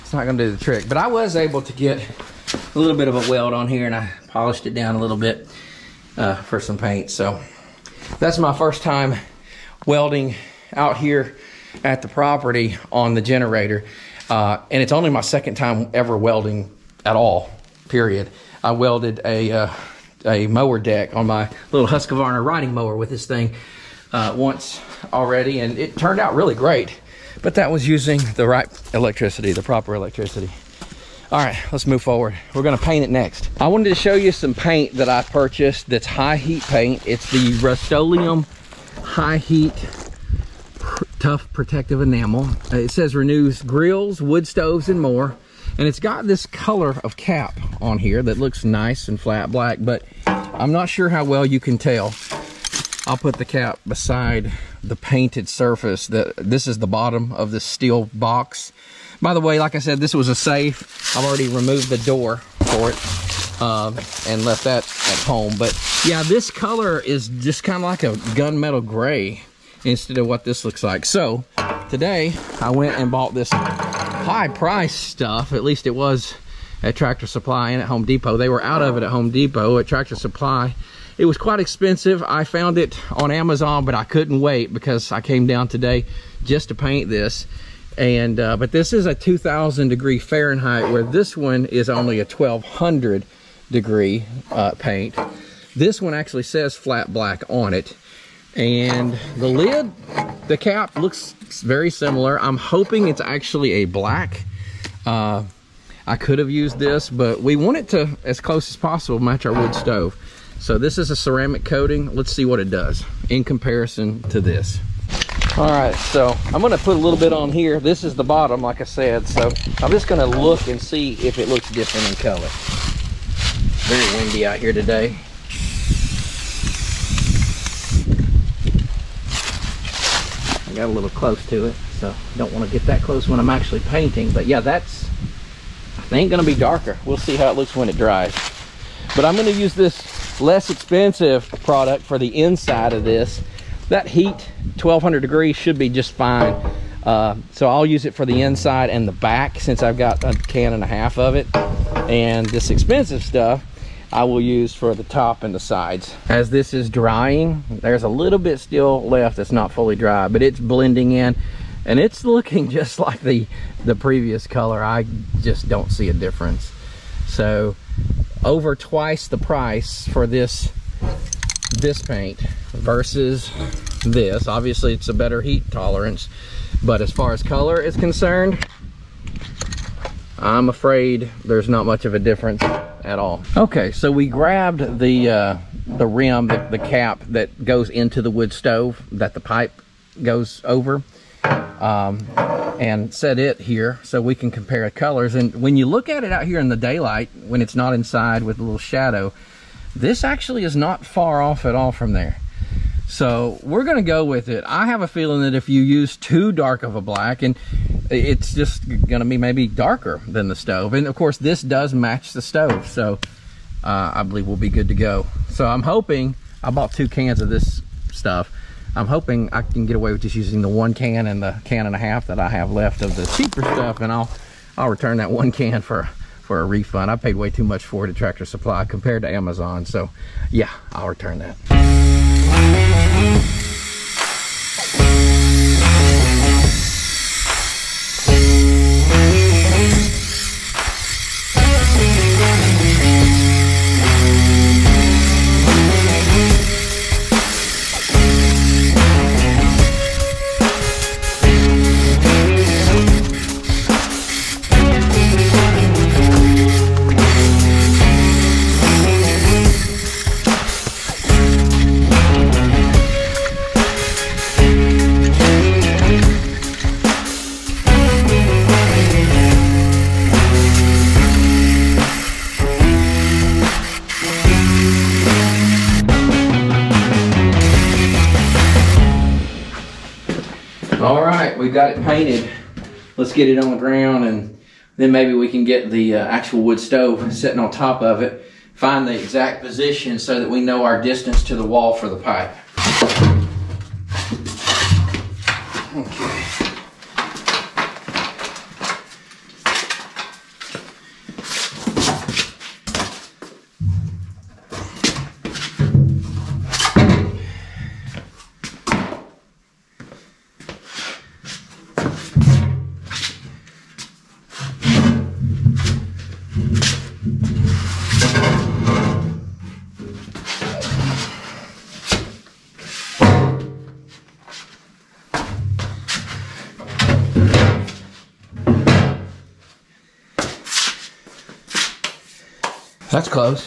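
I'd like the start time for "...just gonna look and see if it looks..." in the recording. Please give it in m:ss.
1:59.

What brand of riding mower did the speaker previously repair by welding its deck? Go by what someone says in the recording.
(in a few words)
Husqvarna.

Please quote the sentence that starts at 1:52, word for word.
Let's see what it does in comparison to this.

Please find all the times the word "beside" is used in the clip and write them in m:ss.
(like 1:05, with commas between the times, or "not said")
0:53.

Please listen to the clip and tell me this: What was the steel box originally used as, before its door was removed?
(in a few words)
A safe.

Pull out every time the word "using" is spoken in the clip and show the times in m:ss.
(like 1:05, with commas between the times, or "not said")
0:27, 3:40.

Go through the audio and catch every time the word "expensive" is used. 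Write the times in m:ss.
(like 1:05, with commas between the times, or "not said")
1:21, 2:20, 2:32.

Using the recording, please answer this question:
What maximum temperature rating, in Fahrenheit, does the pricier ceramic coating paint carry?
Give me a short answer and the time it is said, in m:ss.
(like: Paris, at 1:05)
2,000 degrees, at 1:29.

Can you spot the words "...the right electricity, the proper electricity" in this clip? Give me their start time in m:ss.
0:28.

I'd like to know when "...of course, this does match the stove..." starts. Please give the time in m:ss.
3:31.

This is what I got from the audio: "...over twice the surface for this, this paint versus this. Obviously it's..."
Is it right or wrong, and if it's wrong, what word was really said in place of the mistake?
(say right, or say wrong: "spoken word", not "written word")
wrong: "price", not "surface".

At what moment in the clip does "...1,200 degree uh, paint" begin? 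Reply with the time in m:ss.
1:32.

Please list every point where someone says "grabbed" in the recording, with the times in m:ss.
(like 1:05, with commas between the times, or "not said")
3:04.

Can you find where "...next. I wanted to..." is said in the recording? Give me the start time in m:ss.
0:33.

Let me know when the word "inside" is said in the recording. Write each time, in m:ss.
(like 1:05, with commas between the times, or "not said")
2:22, 2:28, 3:17.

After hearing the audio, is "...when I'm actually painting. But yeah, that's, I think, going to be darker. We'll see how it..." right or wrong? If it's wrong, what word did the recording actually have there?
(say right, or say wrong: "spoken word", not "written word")
right.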